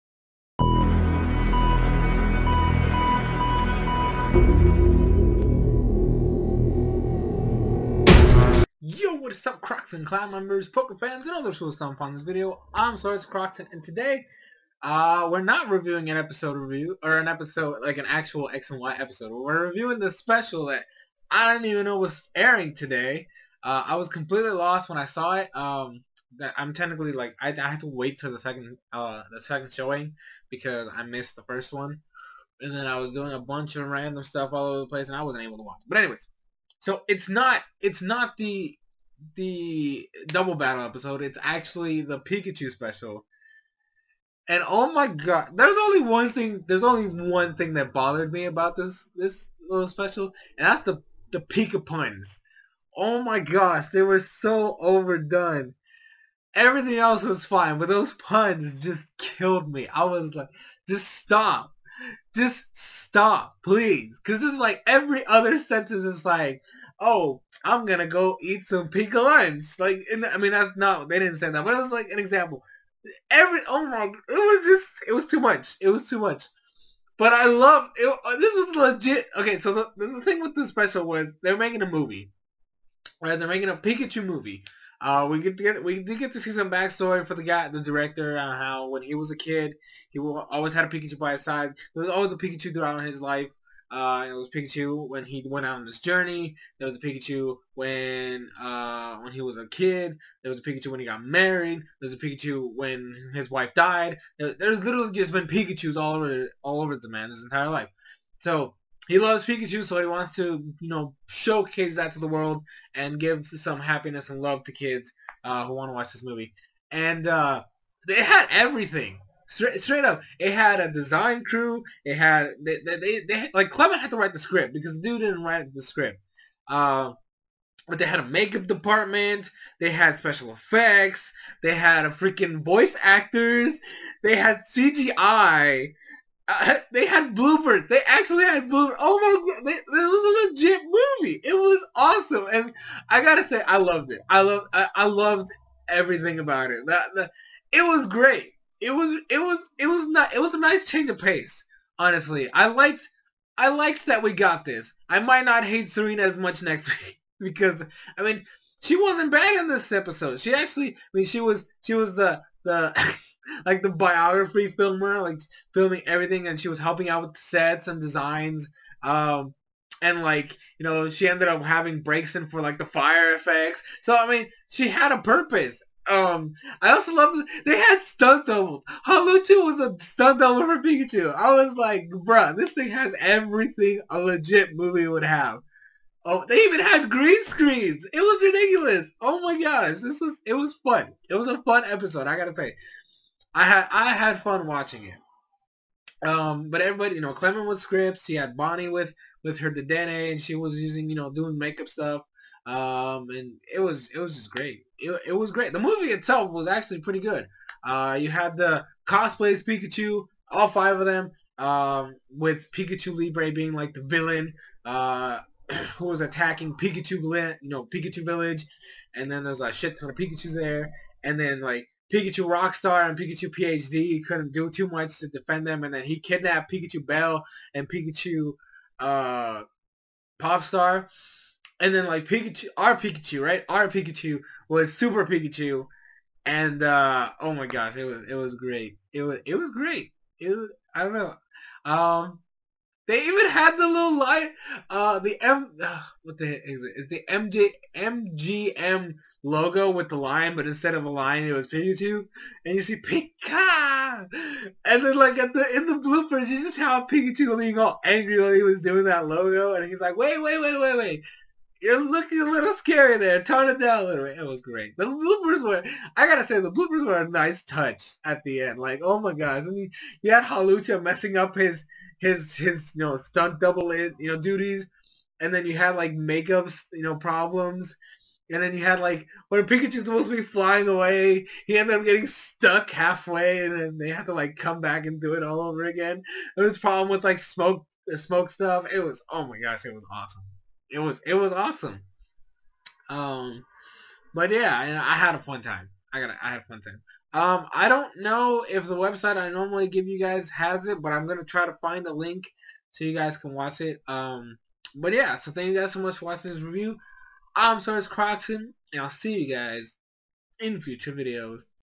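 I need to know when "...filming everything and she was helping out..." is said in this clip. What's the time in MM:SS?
02:45.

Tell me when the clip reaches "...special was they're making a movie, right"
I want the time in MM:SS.
01:20.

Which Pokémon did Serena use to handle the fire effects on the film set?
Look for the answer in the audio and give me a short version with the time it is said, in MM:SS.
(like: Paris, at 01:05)
Braixen, at 02:52.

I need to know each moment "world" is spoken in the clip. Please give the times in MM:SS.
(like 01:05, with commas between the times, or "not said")
01:52.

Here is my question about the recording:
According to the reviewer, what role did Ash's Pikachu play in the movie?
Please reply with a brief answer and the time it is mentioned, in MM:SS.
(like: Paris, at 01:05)
Super Pikachu, at 03:54.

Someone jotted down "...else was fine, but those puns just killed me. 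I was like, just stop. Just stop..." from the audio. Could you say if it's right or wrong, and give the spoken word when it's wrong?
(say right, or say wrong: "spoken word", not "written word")
right.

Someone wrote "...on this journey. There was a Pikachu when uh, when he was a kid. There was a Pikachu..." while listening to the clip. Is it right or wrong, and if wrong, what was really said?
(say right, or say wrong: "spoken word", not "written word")
right.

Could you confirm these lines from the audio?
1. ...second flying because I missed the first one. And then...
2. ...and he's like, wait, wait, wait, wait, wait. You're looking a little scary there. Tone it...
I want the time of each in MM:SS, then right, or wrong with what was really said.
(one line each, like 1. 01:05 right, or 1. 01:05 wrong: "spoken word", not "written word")
1. 00:29 wrong: "showing", not "flying"
2. 04:19 right.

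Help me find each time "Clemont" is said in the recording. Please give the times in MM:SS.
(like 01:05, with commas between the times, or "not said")
02:03, 03:17.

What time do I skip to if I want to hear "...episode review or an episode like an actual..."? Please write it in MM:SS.
00:16.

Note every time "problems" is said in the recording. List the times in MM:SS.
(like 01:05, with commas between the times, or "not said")
04:37, 04:46.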